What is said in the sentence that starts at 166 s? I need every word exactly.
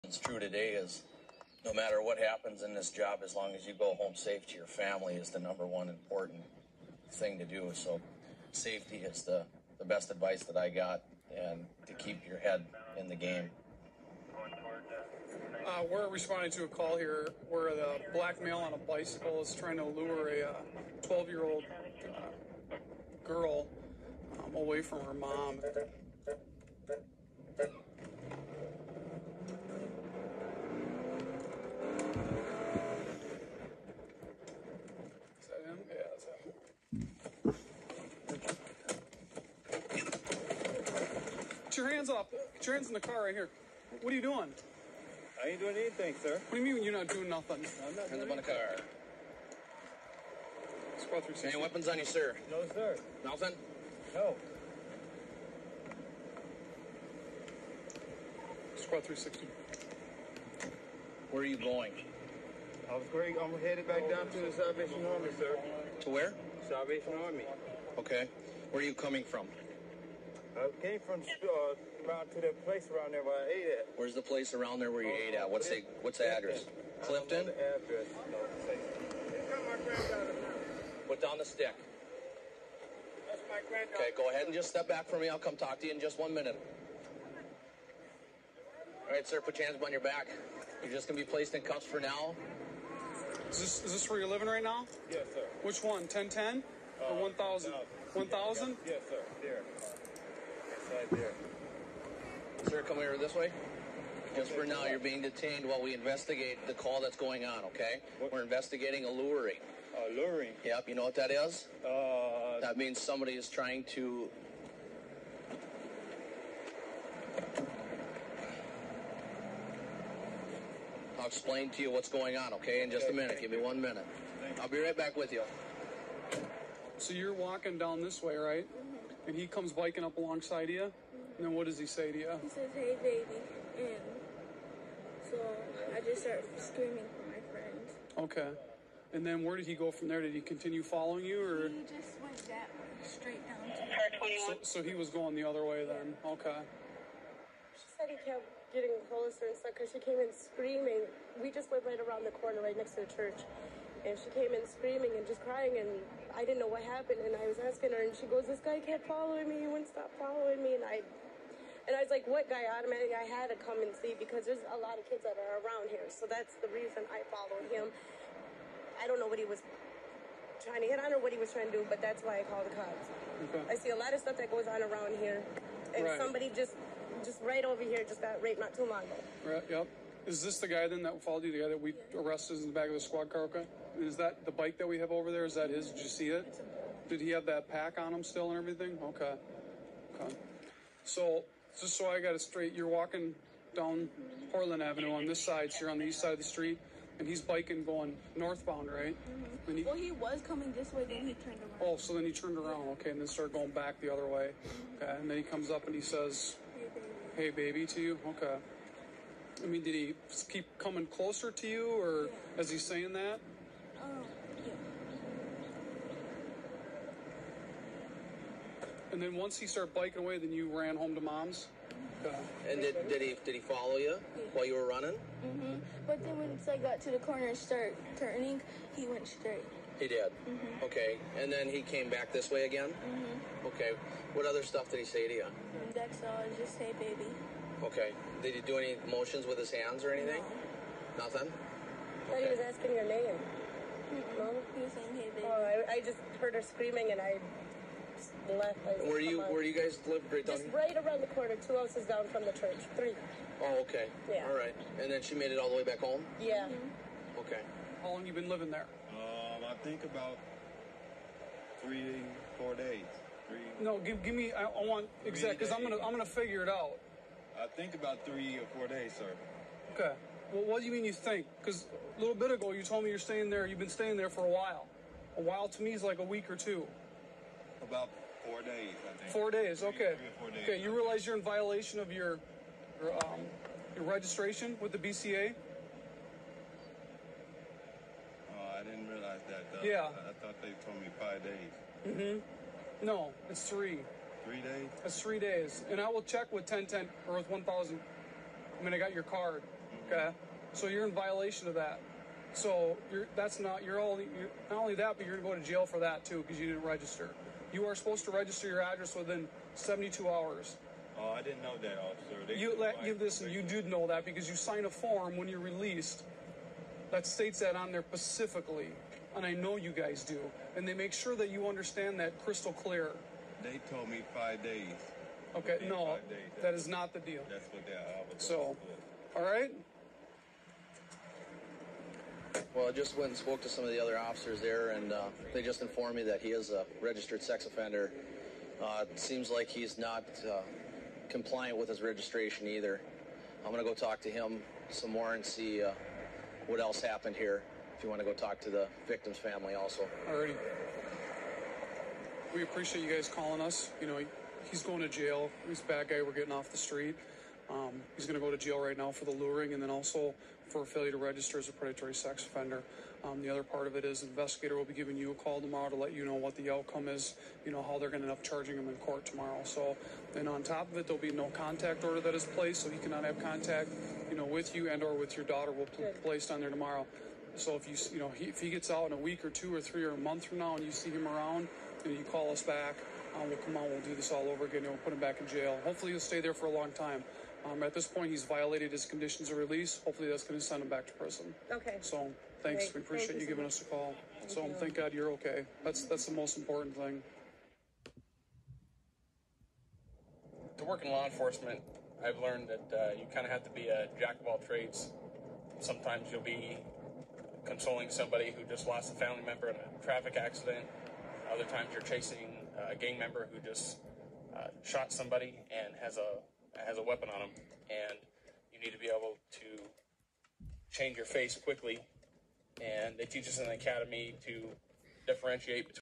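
So that's the reason I followed him.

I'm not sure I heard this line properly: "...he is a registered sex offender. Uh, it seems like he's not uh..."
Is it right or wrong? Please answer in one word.
right.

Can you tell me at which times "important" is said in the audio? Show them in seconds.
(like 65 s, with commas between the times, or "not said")
5 s, 396 s.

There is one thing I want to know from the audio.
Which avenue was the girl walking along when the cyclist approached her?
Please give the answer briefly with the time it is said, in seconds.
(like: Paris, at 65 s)
Portland Avenue, at 194 s.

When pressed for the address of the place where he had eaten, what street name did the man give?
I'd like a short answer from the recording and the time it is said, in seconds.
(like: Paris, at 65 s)
Clifton, at 77 s.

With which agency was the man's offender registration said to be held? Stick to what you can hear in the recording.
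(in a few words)
BCA.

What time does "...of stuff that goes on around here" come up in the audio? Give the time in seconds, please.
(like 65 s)
174 s.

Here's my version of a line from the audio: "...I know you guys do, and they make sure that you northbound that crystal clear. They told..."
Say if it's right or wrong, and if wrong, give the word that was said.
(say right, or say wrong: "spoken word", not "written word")
wrong: "understand", not "northbound".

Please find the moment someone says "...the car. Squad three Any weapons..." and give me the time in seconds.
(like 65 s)
48 s.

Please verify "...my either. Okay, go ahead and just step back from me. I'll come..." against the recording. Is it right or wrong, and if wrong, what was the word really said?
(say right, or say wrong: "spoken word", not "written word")
wrong: "granddaughter", not "either".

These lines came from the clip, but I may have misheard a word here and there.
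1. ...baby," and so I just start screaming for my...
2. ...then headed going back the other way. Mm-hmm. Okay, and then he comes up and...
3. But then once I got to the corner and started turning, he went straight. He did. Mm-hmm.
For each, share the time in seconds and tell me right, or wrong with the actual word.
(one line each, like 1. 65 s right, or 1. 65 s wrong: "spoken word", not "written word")
1. 133 s right
2. 203 s wrong: "started", not "headed"
3. 226 s right.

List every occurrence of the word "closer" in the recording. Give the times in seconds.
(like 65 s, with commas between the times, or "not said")
149 s, 211 s.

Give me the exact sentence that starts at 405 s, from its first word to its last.
Sometimes you'll be consoling somebody who just lost a family member in a traffic accident.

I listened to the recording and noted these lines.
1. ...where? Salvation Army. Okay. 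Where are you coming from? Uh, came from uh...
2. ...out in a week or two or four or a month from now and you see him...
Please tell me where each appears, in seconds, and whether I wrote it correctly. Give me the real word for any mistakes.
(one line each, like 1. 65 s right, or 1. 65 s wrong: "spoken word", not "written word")
1. 66 s right
2. 378 s wrong: "three", not "four".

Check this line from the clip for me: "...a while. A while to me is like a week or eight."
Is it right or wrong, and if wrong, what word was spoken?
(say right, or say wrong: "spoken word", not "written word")
wrong: "two", not "eight".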